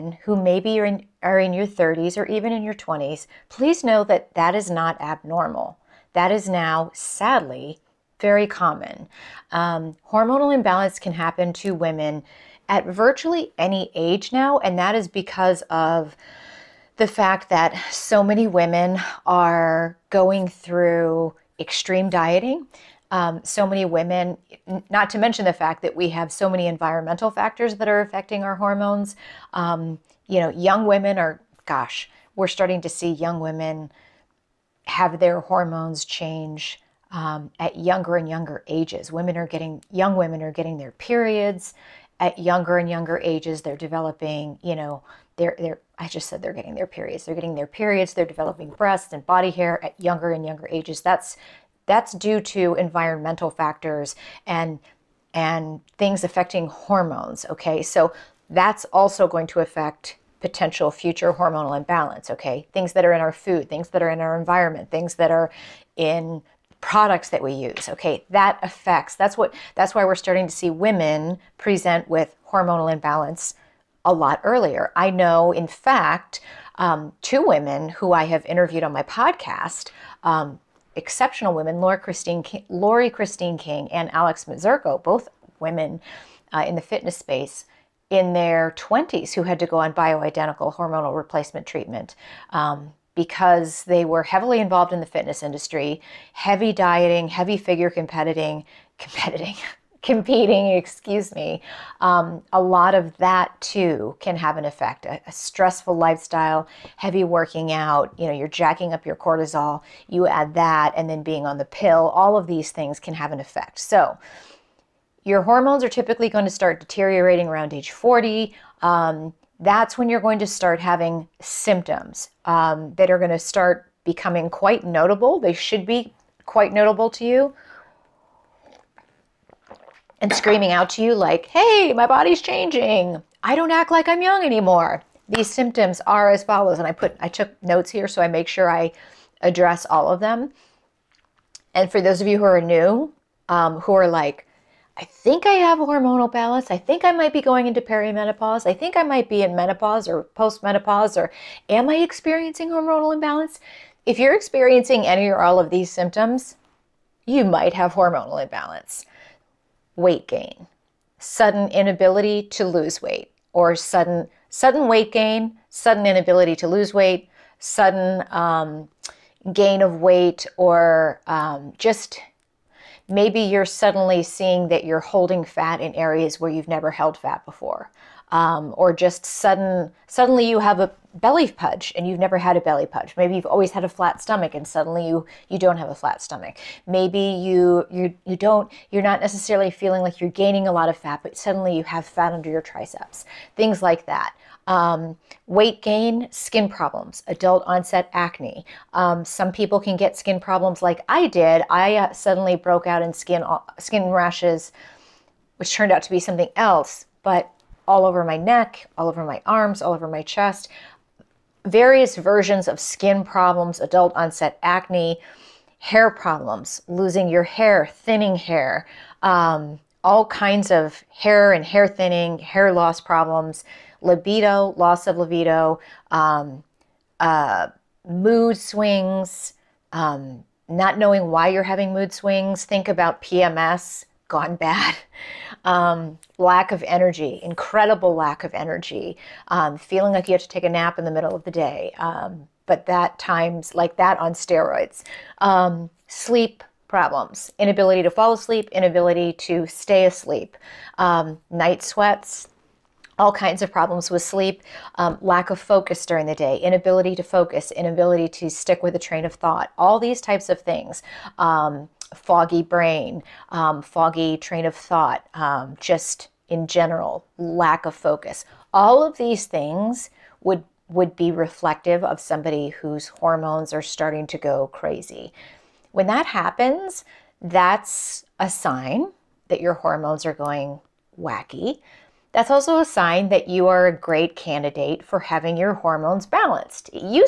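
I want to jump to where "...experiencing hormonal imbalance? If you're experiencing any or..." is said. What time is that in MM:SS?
02:31.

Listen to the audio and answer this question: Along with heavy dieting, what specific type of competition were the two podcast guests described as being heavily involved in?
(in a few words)
figure competing.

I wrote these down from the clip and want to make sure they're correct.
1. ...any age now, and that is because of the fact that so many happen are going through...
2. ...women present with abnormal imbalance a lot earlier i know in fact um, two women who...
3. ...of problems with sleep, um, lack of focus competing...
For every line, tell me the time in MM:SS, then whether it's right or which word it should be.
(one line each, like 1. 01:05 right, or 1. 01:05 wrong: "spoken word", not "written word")
1. 00:13 wrong: "women", not "happen"
2. 01:10 wrong: "hormonal", not "abnormal"
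3. 04:13 wrong: "during", not "competing".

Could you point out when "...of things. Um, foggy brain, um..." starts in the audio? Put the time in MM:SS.
04:20.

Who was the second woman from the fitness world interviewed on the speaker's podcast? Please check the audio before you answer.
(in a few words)
Alex Mazzurco.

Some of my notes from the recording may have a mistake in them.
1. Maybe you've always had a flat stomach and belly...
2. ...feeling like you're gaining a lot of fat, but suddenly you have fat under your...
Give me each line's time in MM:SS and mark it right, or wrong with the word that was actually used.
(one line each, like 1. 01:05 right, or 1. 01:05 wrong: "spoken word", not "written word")
1. 03:03 wrong: "suddenly", not "belly"
2. 03:09 right.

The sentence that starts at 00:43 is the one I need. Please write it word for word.
They're developing, you know, they're, they're, I just said they're getting their periods.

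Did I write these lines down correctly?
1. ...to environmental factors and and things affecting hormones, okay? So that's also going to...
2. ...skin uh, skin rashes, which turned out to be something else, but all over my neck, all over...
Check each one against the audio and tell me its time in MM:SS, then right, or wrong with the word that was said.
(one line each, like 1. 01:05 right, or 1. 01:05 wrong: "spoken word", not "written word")
1. 00:52 right
2. 03:23 right.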